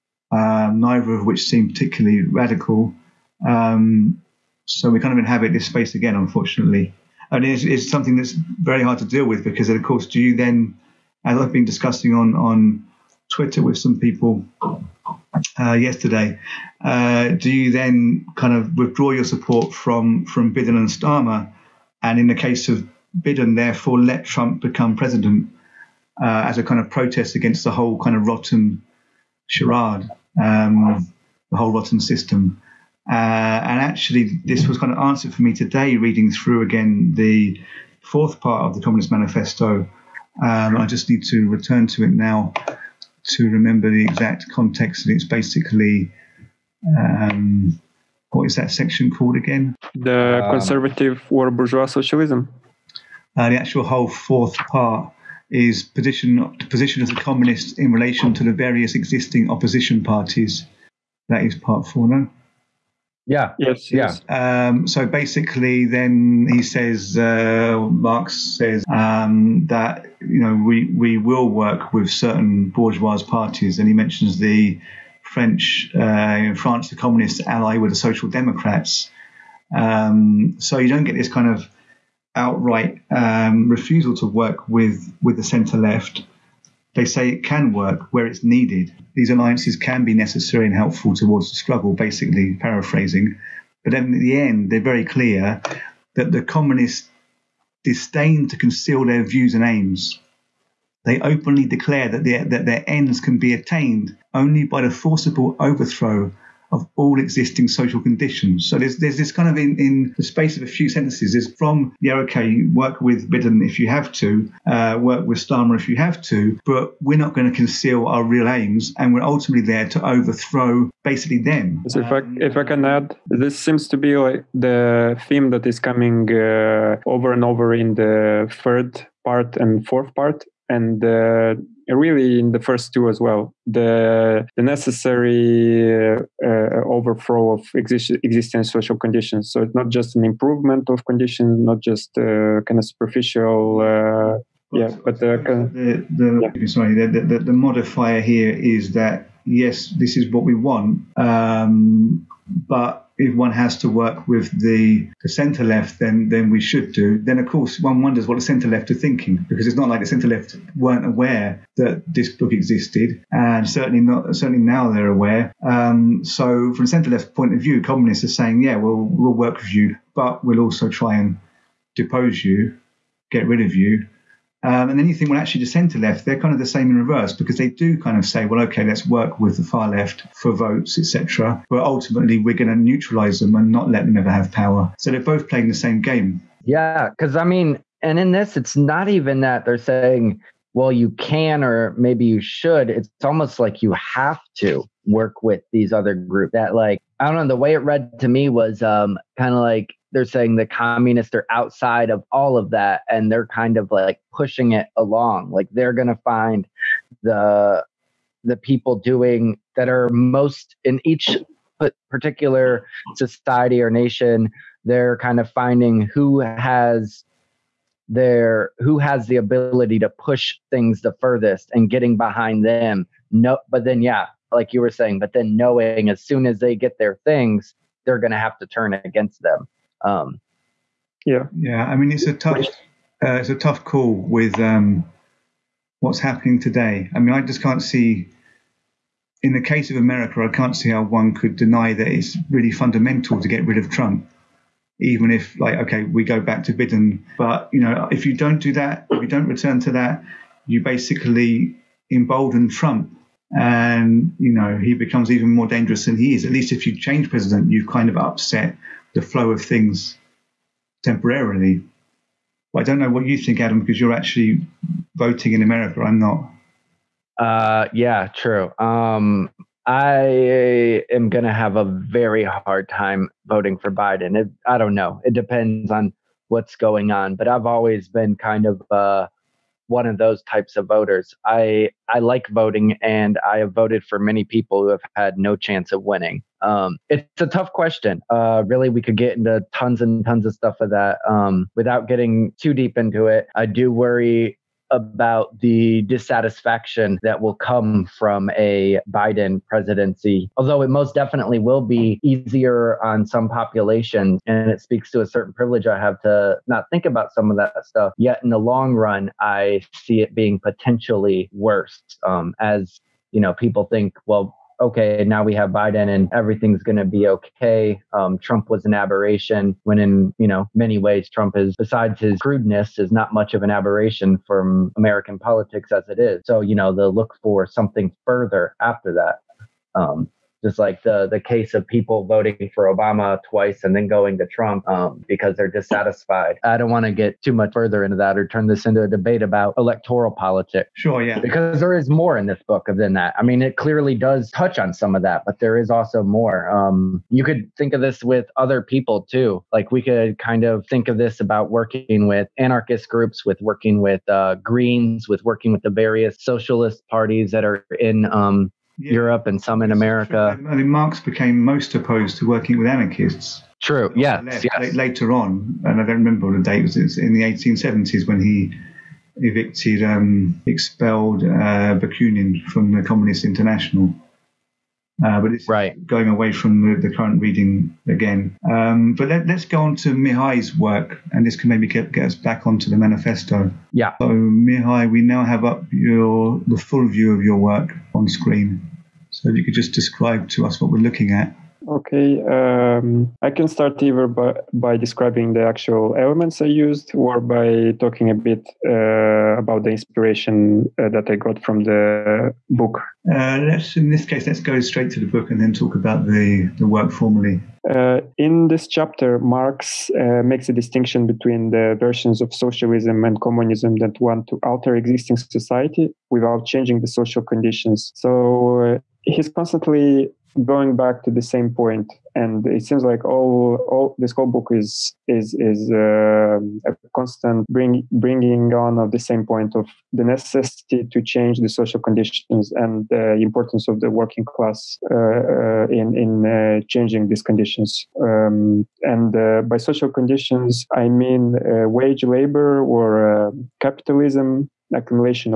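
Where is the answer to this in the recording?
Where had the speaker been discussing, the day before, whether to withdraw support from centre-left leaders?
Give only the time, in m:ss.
0:13.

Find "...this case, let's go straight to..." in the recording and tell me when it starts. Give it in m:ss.
6:44.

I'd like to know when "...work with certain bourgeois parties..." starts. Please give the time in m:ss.
1:11.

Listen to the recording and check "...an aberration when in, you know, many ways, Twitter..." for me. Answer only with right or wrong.
wrong.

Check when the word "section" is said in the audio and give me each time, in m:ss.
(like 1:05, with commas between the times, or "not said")
0:48.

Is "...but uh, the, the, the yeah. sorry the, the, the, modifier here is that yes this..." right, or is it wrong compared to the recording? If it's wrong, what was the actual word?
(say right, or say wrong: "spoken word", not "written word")
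right.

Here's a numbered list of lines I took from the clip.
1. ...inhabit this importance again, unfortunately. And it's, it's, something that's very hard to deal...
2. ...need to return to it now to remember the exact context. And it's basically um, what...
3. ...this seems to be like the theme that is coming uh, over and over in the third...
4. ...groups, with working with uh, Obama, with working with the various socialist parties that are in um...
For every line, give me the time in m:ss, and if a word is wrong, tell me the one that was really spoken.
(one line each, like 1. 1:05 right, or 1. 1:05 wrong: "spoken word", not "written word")
1. 0:05 wrong: "space", not "importance"
2. 0:41 right
3. 2:03 right
4. 5:53 wrong: "Greens", not "Obama".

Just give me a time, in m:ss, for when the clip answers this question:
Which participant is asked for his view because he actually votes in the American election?
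4:23.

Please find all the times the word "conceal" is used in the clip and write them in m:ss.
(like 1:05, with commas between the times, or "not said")
1:38, 1:57.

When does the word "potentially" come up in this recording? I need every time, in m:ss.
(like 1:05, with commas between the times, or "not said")
5:10.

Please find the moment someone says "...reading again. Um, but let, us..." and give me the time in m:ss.
6:17.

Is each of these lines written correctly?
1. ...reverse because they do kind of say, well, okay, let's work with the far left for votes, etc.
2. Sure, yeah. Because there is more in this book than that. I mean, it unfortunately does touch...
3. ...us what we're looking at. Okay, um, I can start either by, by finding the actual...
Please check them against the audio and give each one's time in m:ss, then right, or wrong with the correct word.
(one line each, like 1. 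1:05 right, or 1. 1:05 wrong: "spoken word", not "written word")
1. 2:56 right
2. 5:40 wrong: "clearly", not "unfortunately"
3. 6:30 wrong: "describing", not "finding".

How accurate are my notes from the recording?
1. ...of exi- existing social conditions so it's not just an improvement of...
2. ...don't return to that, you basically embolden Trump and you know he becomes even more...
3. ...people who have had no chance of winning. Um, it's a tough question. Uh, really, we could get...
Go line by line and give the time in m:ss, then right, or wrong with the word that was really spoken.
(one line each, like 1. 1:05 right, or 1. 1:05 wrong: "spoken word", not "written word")
1. 2:17 right
2. 4:09 right
3. 4:44 right.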